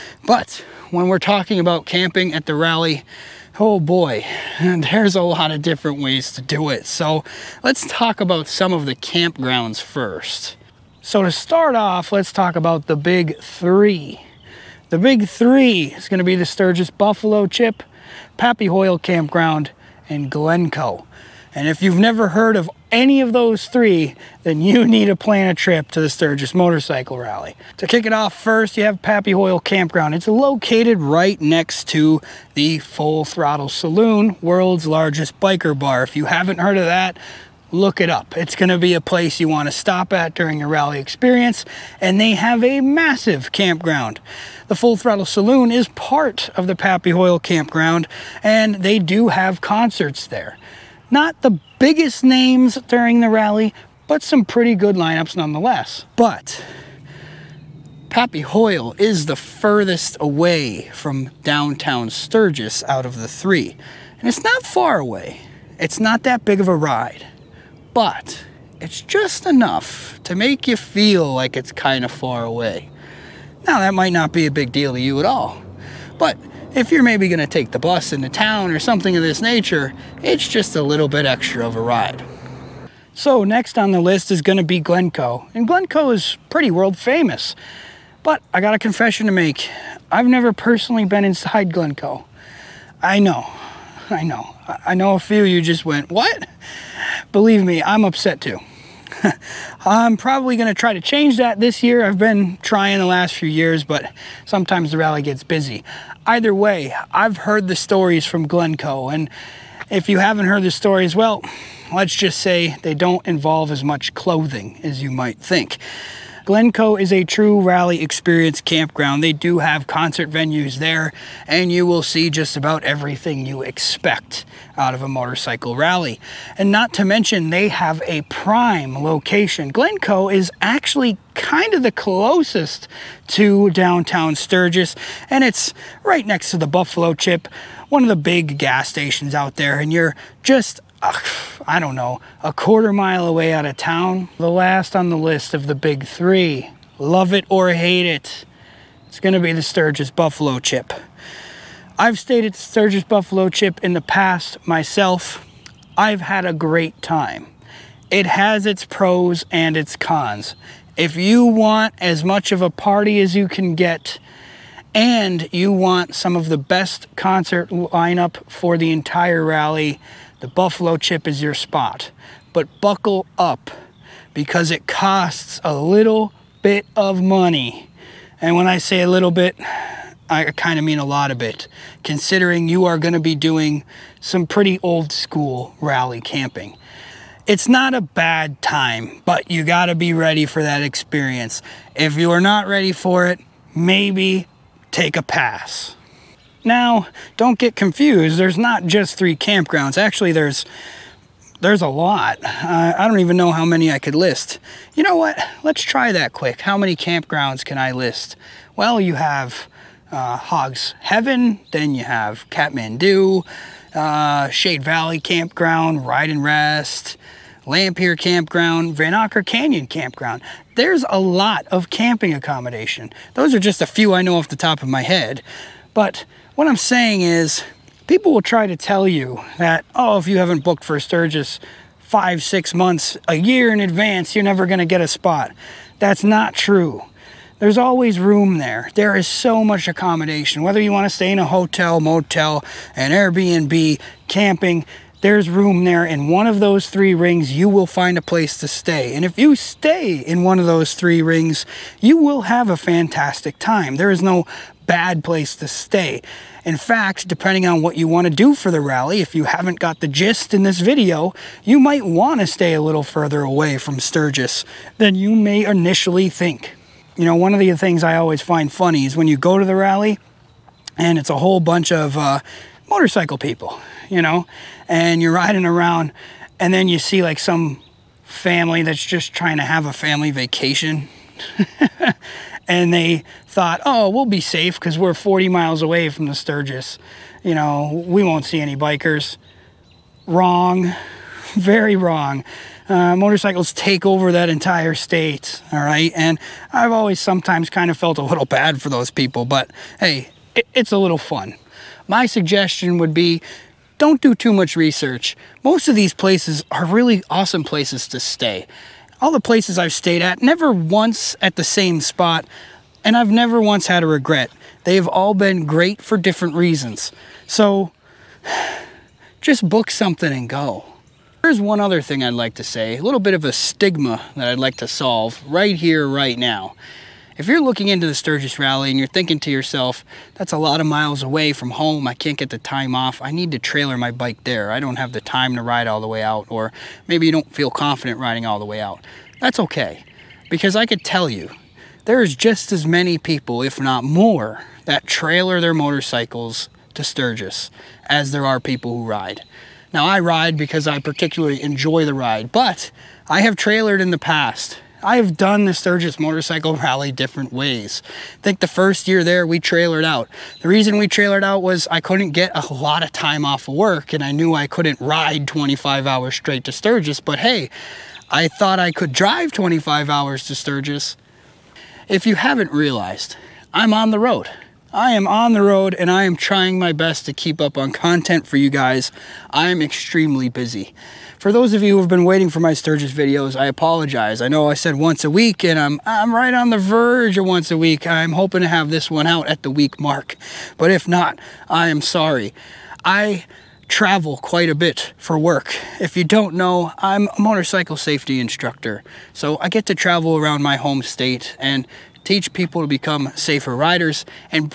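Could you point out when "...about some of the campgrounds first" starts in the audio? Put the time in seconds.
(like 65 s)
8 s.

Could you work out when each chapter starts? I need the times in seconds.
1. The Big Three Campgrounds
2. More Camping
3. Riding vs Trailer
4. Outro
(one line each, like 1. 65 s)
1. 11 s
2. 196 s
3. 321 s
4. 371 s.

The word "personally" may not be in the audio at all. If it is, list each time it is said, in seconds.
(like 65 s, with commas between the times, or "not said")
90 s.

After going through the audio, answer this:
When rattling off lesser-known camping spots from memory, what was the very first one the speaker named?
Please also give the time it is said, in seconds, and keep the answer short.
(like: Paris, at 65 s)
Hogs Heaven, at 210 s.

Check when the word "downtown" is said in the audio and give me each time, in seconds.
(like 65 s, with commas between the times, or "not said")
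61 s, 133 s.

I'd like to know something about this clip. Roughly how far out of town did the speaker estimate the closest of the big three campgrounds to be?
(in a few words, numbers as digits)
a quarter mile.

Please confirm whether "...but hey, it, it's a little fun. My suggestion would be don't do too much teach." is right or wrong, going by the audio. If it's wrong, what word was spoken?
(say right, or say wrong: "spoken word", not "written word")
wrong: "research", not "teach".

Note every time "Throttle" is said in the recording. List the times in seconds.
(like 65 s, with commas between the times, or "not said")
33 s, 44 s.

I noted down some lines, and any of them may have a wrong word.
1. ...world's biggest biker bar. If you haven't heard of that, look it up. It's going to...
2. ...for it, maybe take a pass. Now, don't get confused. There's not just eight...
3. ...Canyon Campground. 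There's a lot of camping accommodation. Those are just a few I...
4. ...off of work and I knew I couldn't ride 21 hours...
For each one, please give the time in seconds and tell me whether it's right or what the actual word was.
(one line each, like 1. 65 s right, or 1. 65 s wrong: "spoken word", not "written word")
1. 34 s wrong: "largest", not "biggest"
2. 192 s wrong: "three", not "eight"
3. 219 s right
4. 363 s wrong: "25", not "21".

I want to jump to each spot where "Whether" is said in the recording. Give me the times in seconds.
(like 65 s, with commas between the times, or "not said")
240 s.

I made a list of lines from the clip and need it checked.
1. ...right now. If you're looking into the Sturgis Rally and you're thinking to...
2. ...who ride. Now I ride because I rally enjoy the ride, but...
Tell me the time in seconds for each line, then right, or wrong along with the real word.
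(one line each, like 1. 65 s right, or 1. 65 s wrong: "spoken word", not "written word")
1. 326 s right
2. 348 s wrong: "particularly", not "rally".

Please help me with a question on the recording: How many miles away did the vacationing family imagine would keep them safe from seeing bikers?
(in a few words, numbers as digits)
40 miles.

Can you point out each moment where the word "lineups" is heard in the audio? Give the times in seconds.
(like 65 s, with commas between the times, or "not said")
54 s, 167 s.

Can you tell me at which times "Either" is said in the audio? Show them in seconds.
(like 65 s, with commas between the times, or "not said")
106 s.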